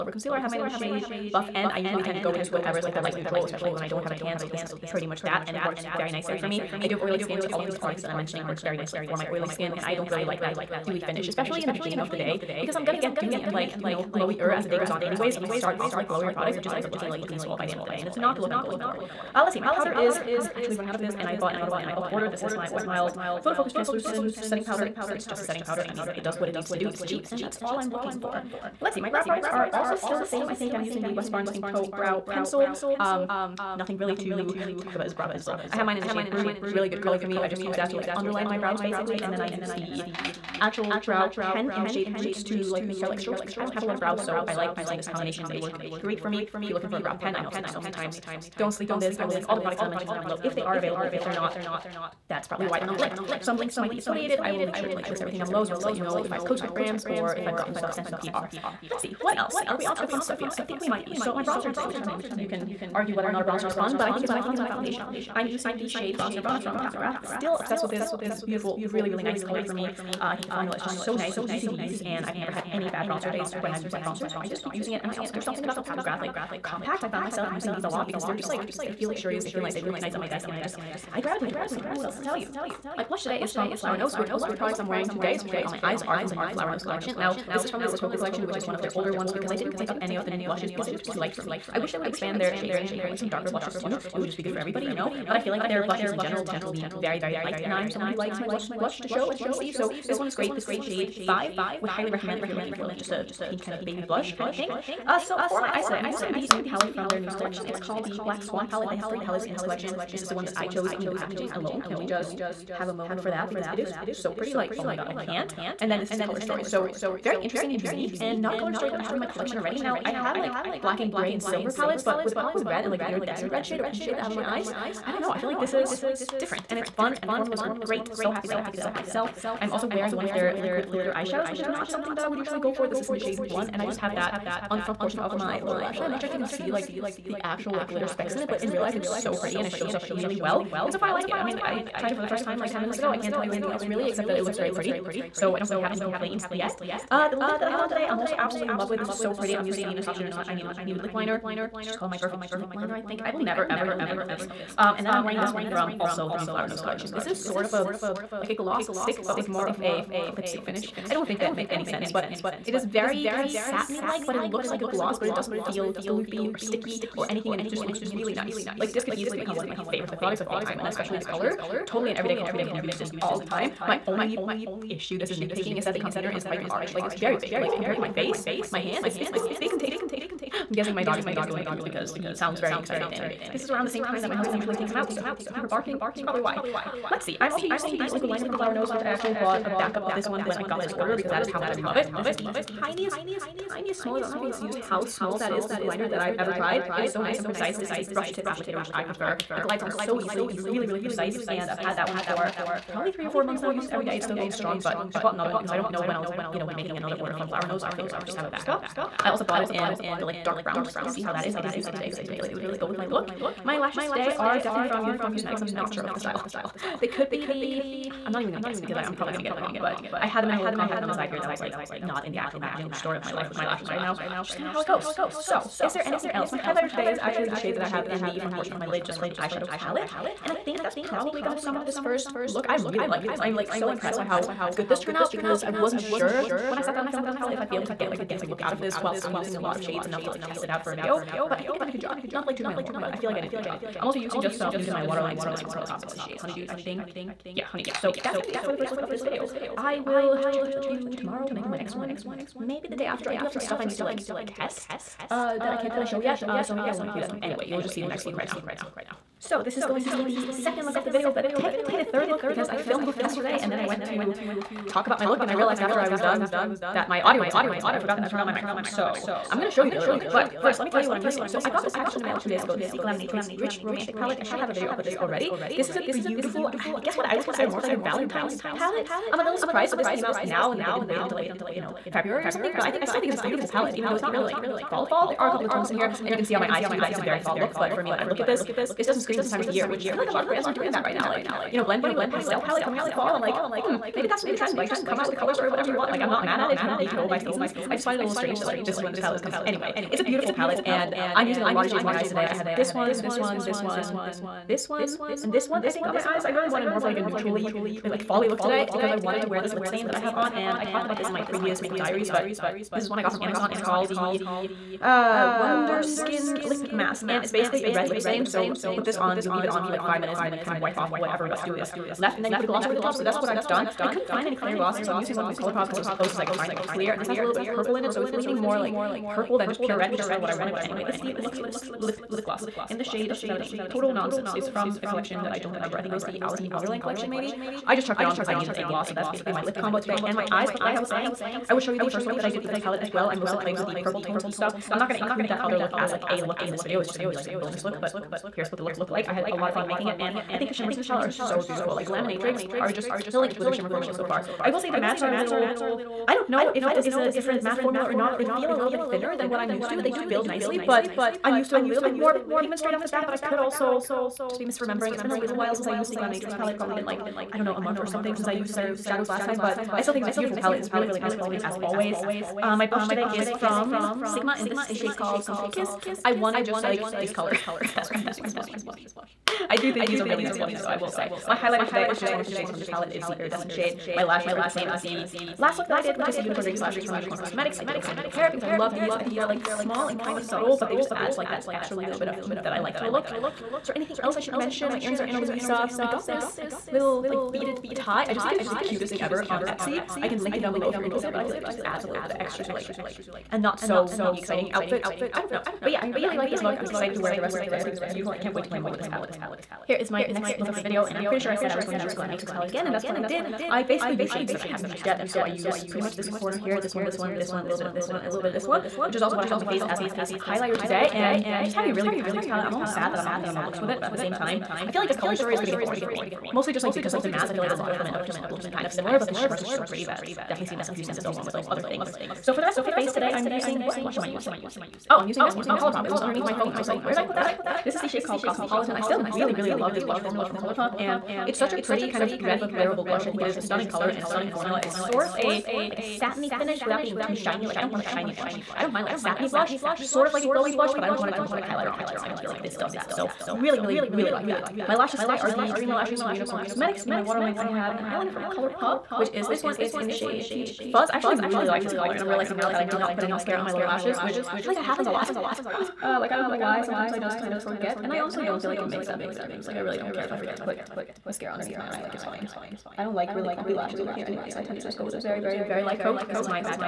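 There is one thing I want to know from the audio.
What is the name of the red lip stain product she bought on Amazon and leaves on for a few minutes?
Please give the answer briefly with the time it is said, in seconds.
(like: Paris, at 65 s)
Wonder Skin Lip Mask, at 315 s.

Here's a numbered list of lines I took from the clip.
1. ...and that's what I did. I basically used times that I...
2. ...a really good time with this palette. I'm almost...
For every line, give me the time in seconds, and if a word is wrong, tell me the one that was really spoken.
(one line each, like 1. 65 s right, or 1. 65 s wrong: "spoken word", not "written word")
1. 412 s wrong: "shades", not "times"
2. 421 s right.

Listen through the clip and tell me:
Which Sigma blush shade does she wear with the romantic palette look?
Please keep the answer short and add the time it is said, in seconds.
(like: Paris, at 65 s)
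Sunset Kiss, at 375 s.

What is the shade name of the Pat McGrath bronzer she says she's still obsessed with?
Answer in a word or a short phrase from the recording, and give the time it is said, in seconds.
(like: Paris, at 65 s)
Bronze Nirvana, at 66 s.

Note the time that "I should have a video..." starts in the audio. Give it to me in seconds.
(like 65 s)
274 s.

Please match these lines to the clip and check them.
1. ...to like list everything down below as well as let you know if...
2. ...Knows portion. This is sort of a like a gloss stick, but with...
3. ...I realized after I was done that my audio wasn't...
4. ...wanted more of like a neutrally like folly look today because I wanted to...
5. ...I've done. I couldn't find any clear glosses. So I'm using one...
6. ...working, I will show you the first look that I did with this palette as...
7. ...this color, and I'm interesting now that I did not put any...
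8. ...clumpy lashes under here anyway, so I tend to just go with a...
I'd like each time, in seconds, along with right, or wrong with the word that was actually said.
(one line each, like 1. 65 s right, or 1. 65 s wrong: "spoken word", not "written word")
1. 54 s right
2. 156 s wrong: "collection", not "portion"
3. 265 s right
4. 306 s right
5. 323 s right
6. 341 s wrong: "saying", not "working"
7. 461 s wrong: "realizing", not "interesting"
8. 473 s right.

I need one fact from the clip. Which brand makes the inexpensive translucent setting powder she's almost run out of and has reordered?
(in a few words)
Wet n Wild.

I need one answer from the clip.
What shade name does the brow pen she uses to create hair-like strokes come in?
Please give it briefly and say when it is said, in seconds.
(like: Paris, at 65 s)
Roots, at 42 s.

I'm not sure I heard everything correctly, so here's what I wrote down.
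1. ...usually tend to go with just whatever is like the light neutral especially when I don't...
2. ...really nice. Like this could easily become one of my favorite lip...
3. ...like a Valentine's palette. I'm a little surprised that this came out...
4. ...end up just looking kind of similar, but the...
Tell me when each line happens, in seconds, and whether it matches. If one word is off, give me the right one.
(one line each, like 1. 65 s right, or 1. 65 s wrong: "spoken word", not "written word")
1. 1 s right
2. 168 s right
3. 277 s right
4. 428 s right.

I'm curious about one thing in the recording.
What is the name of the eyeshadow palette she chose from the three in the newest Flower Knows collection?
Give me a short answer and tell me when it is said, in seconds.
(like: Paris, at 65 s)
Black Swan, at 108 s.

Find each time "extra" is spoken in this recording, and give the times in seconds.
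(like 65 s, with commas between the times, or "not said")
391 s, 402 s.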